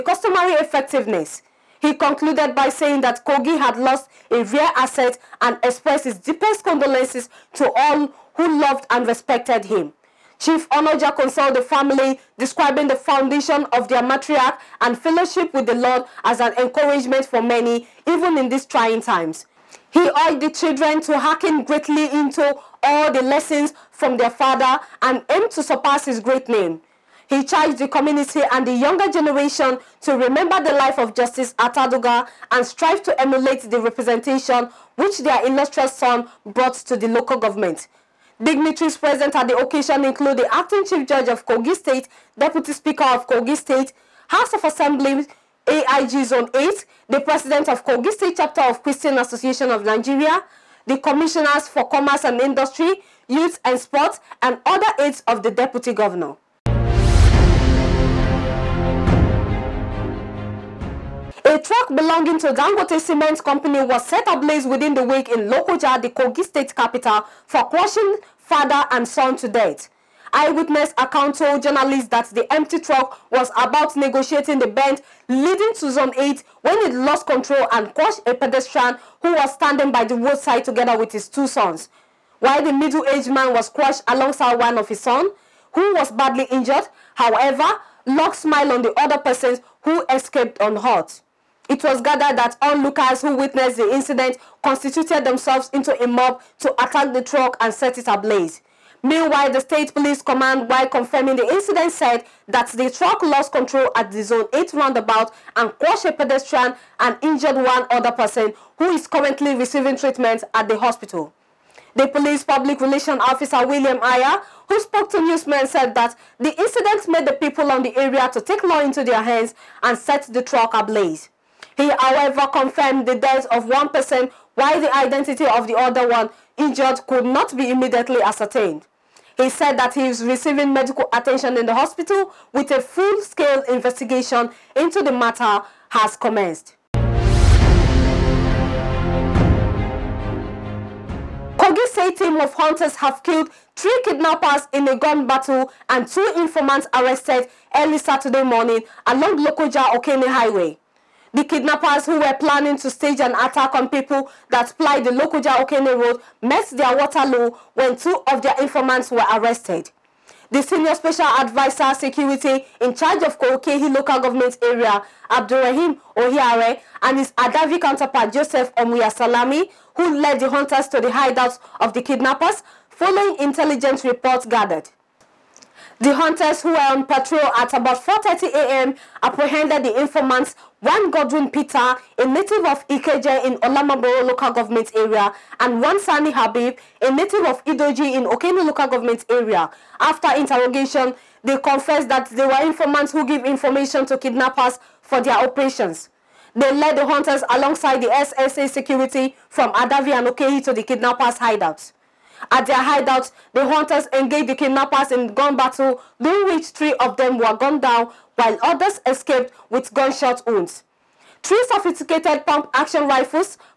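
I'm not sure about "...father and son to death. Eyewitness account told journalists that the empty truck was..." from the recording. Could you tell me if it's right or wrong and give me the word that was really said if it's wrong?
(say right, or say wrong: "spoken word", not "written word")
right.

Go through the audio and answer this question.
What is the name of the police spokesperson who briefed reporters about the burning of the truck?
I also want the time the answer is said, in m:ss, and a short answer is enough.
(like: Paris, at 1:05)
William Aya, at 1:53.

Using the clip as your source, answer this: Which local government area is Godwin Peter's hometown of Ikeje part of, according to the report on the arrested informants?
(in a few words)
Olamaboro.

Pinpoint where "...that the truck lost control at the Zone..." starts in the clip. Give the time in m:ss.
1:42.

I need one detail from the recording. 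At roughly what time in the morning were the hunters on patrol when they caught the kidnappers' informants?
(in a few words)
4.30 a.m.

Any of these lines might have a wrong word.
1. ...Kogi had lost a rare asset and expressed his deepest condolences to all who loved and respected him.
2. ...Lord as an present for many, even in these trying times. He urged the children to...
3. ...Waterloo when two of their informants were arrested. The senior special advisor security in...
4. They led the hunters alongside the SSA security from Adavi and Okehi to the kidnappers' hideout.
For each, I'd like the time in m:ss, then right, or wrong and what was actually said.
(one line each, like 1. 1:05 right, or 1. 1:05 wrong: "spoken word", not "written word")
1. 0:03 right
2. 0:15 wrong: "encouragement", not "present"
3. 2:36 right
4. 3:16 right.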